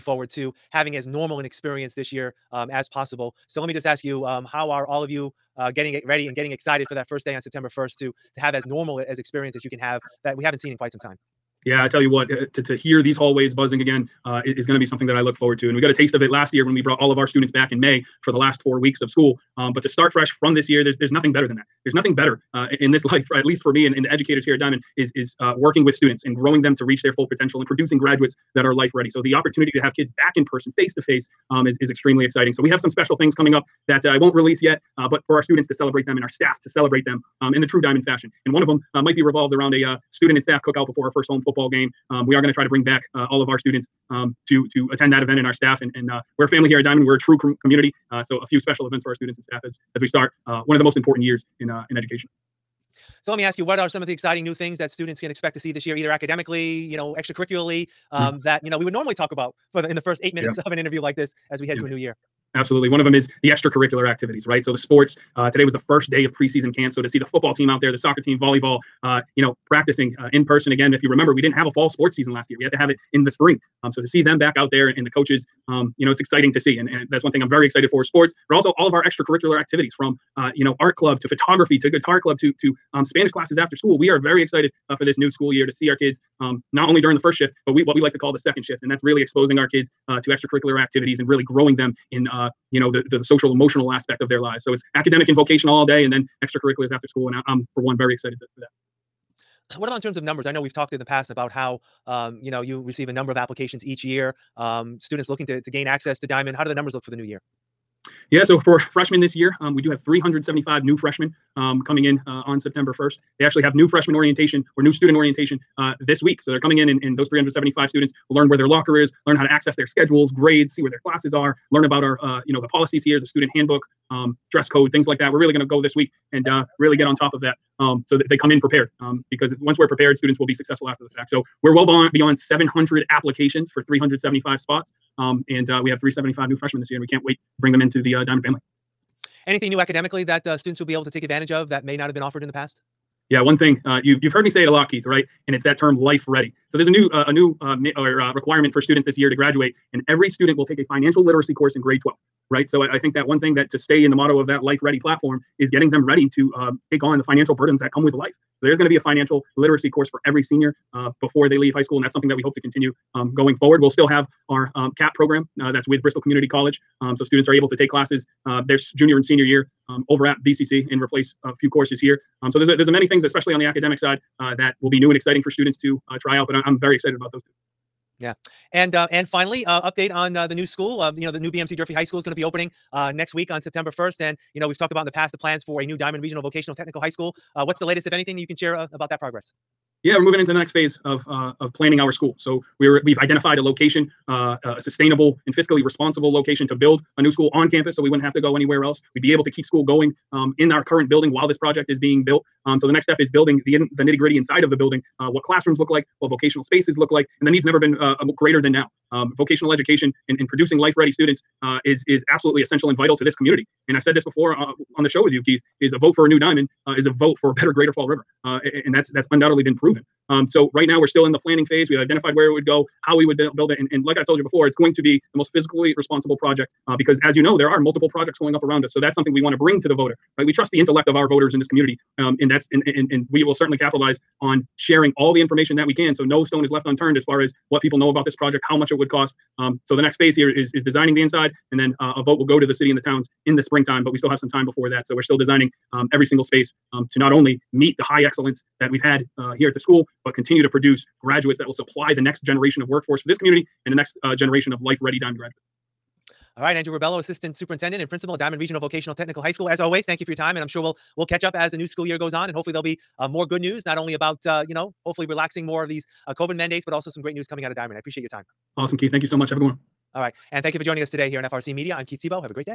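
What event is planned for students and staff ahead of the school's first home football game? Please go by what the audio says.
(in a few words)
cookout.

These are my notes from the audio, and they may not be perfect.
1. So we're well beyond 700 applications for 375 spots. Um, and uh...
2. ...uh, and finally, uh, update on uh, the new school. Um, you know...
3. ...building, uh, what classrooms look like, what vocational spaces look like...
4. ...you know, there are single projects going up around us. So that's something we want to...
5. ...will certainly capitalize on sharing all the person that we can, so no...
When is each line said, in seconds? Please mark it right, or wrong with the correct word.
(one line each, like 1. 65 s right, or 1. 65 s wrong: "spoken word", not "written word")
1. 131 s right
2. 178 s right
3. 204 s right
4. 227 s wrong: "multiple", not "single"
5. 233 s wrong: "information", not "person".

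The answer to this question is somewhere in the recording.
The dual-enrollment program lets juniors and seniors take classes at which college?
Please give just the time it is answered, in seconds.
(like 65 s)
166 s.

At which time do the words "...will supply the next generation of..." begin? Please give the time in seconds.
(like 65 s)
251 s.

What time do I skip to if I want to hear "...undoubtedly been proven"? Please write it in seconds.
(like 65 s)
219 s.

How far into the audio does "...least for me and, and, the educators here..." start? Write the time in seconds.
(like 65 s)
23 s.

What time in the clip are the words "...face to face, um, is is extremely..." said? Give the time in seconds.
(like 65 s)
30 s.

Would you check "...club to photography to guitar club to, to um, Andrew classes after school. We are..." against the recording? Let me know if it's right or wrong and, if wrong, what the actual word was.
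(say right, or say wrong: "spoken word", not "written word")
wrong: "Spanish", not "Andrew".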